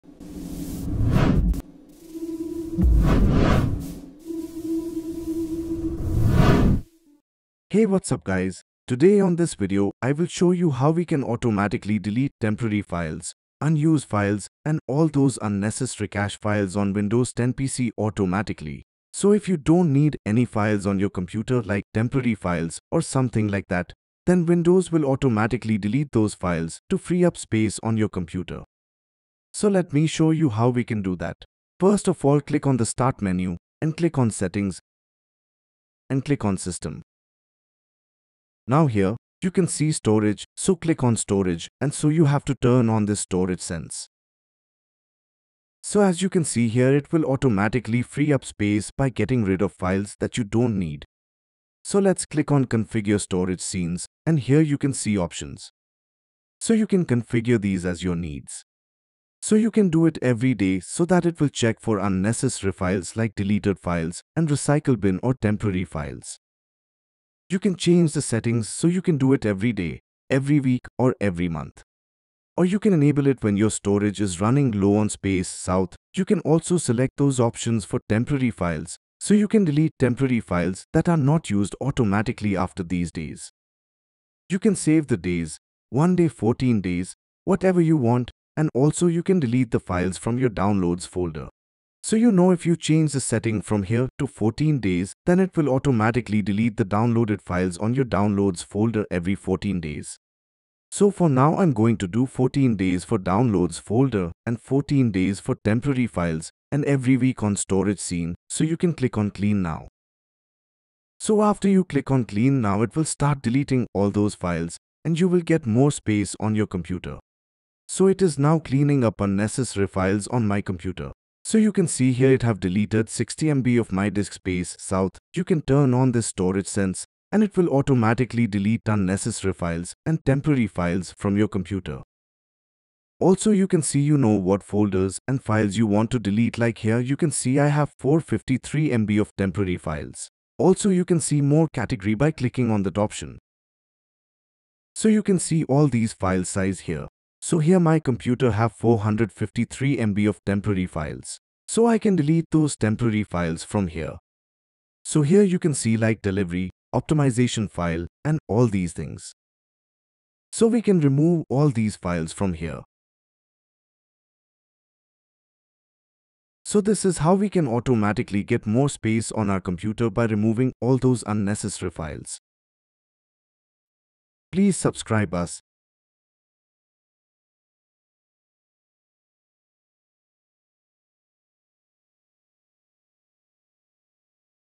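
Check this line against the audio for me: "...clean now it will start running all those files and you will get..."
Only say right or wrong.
wrong.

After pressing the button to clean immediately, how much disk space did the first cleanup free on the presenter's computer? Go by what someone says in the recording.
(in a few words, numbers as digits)
60 MB.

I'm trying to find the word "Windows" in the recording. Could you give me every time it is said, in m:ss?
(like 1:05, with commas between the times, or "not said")
0:16, 0:24.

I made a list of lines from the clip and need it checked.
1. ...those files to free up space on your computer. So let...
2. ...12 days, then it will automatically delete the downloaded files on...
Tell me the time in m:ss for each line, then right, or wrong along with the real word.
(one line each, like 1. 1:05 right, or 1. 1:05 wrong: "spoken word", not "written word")
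1. 0:26 right
2. 1:34 wrong: "14", not "12".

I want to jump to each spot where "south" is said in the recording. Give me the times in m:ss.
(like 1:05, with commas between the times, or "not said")
1:15, 2:04.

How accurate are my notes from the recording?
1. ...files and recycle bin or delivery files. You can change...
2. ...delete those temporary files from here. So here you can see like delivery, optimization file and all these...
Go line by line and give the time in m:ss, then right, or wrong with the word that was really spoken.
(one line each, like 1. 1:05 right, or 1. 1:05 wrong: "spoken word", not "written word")
1. 1:03 wrong: "temporary", not "delivery"
2. 2:32 right.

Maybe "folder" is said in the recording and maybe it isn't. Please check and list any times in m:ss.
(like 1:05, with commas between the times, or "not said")
1:31, 1:38, 1:43, 2:14.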